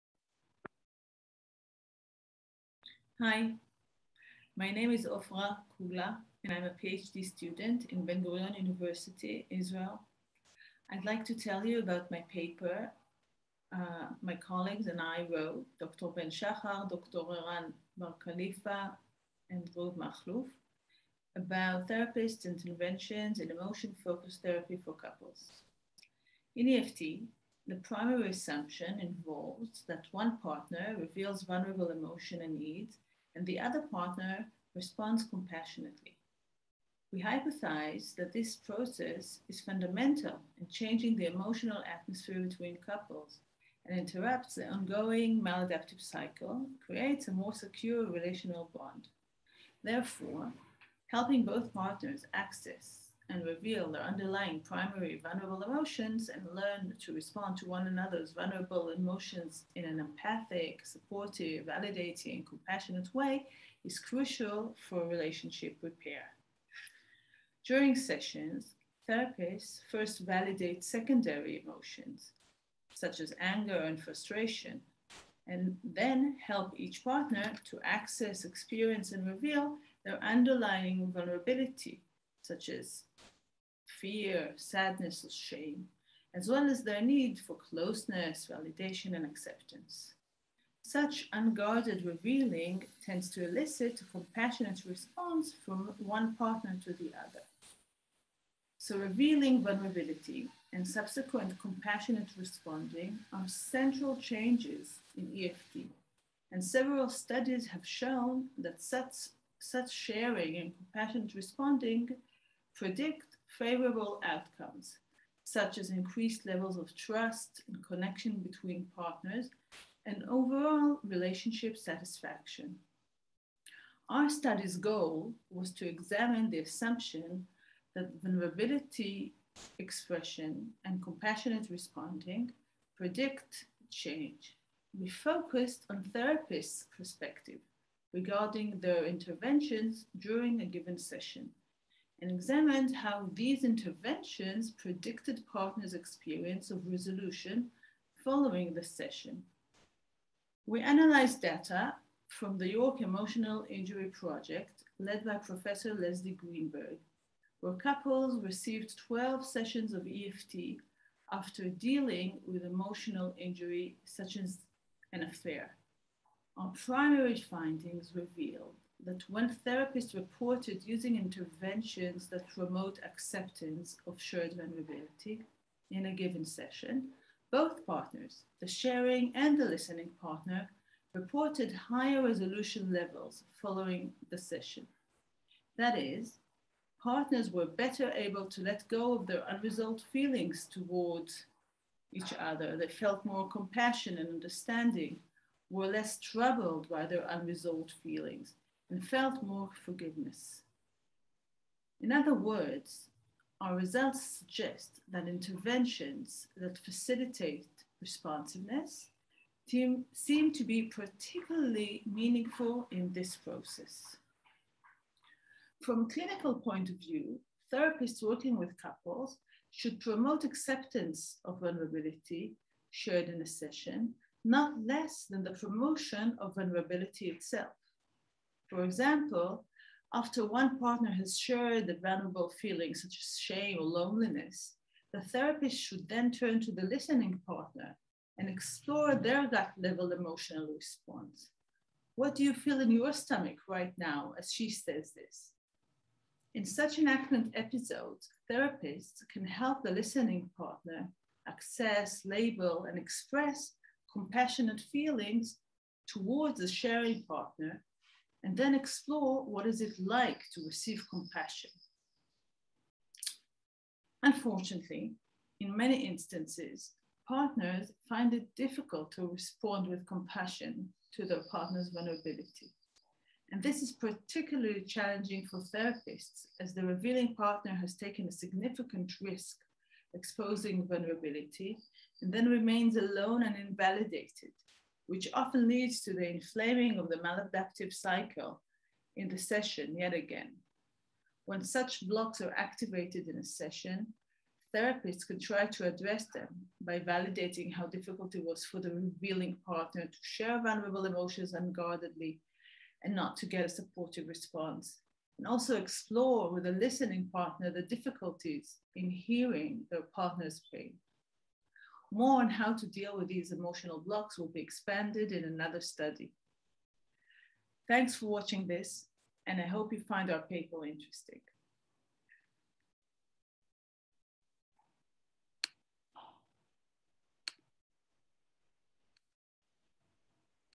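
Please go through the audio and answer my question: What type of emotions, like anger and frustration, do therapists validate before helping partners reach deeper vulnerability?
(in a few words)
Secondary emotions.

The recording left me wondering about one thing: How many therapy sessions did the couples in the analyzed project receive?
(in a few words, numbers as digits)
12.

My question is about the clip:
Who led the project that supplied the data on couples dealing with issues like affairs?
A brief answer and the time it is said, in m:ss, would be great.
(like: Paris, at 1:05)
Leslie Greenberg, at 2:35.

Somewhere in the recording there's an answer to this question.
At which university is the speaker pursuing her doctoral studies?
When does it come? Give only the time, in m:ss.
0:08.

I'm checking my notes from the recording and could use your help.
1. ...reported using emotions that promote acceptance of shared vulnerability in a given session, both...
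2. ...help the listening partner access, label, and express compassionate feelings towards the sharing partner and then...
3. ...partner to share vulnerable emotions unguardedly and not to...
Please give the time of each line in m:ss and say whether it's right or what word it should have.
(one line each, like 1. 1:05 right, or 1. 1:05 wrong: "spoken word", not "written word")
1. 2:50 wrong: "interventions", not "emotions"
2. 4:09 right
3. 4:59 right.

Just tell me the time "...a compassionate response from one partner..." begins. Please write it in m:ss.
1:34.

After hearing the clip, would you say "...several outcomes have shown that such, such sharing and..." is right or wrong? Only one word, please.
wrong.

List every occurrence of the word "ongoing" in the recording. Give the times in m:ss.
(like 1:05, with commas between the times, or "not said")
0:44.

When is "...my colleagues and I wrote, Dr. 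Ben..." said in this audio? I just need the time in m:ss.
0:14.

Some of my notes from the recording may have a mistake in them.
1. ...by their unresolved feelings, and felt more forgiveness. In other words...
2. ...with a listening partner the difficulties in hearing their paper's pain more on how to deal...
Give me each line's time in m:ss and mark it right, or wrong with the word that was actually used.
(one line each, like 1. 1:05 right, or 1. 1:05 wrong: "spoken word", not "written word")
1. 3:16 right
2. 5:06 wrong: "partner", not "paper".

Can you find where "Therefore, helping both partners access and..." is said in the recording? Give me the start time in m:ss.
0:49.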